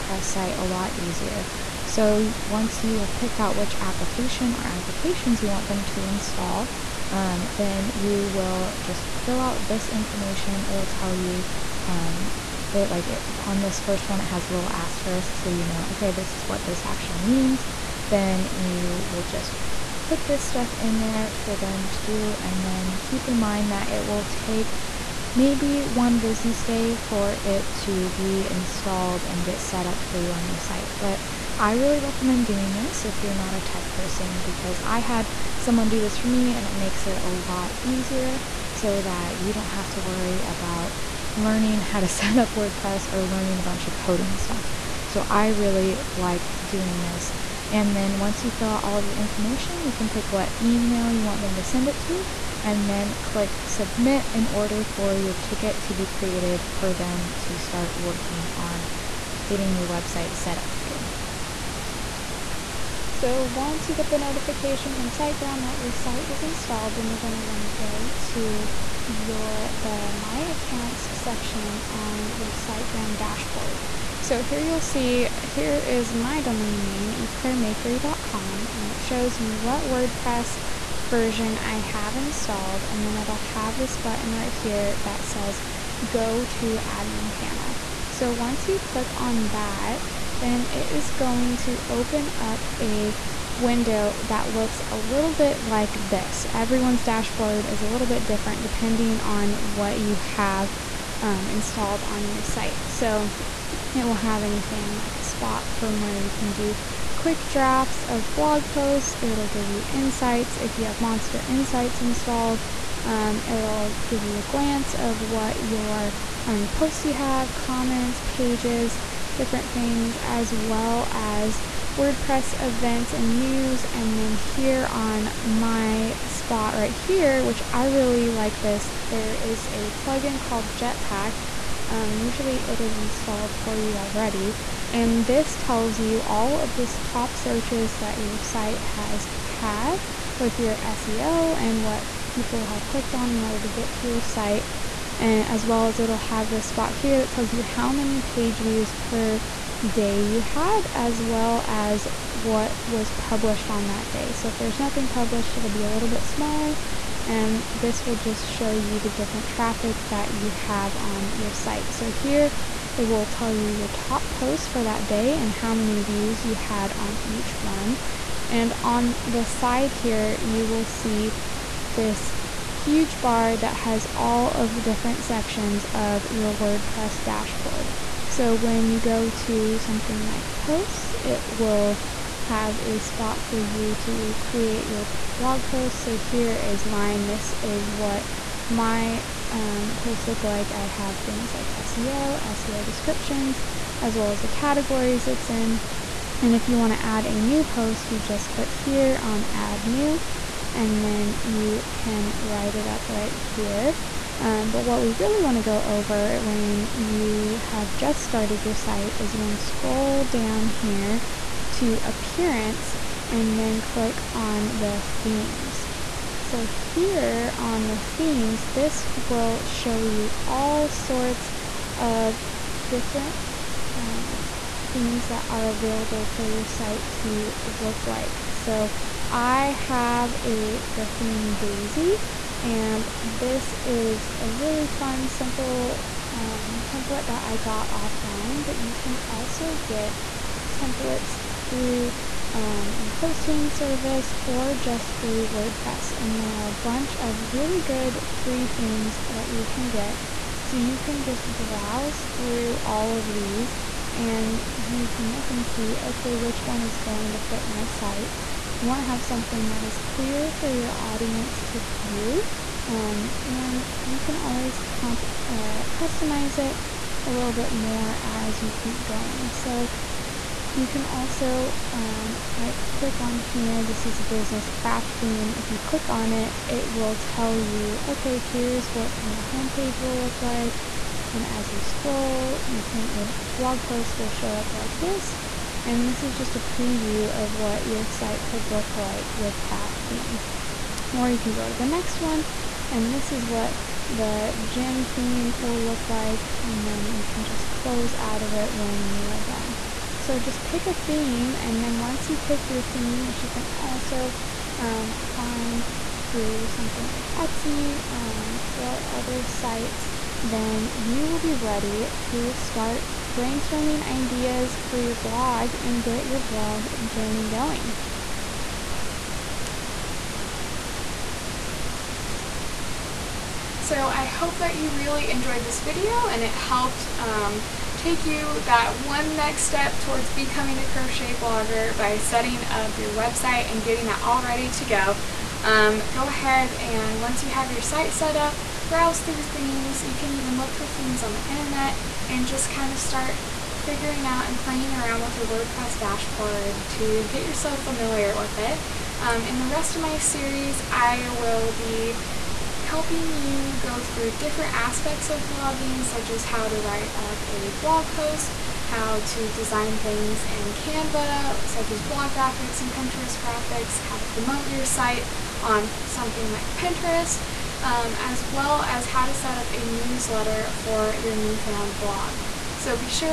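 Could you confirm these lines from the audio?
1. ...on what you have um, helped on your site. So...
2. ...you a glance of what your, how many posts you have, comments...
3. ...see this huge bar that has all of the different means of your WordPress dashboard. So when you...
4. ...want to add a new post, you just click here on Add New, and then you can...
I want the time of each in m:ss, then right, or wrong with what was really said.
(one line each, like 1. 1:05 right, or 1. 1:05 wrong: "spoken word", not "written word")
1. 1:39 wrong: "installed", not "helped"
2. 1:54 right
3. 2:50 wrong: "sections", not "means"
4. 3:16 right.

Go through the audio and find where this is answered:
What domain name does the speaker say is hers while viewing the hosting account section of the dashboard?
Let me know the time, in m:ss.
1:17.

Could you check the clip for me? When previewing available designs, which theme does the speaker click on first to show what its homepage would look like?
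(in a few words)
Business craft theme.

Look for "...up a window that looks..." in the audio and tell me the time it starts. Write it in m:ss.
1:32.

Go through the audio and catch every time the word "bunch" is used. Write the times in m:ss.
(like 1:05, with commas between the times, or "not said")
0:43, 4:06.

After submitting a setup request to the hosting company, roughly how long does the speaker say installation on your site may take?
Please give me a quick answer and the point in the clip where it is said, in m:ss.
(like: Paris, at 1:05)
1 business day, at 0:25.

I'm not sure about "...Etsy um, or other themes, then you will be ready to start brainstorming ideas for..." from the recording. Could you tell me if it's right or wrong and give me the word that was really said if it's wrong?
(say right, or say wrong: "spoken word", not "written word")
wrong: "sites", not "themes".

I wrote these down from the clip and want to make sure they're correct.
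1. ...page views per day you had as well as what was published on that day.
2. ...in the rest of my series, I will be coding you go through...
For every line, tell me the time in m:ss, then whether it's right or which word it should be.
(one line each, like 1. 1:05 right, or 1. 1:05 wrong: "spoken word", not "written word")
1. 2:28 right
2. 5:49 wrong: "helping", not "coding".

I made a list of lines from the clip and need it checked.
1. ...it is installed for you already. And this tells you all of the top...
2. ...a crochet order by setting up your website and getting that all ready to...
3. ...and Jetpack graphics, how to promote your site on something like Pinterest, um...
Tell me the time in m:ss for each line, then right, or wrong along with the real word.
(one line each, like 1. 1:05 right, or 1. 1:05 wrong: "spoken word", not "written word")
1. 2:12 right
2. 5:30 wrong: "blogger", not "order"
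3. 6:02 wrong: "Pinterest", not "Jetpack".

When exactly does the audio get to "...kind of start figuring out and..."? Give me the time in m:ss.
5:42.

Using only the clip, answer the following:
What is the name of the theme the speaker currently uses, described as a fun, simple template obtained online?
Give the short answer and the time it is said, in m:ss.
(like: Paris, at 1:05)
Daisy, at 3:51.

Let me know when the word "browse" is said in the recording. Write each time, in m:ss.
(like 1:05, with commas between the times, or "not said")
4:11, 5:38.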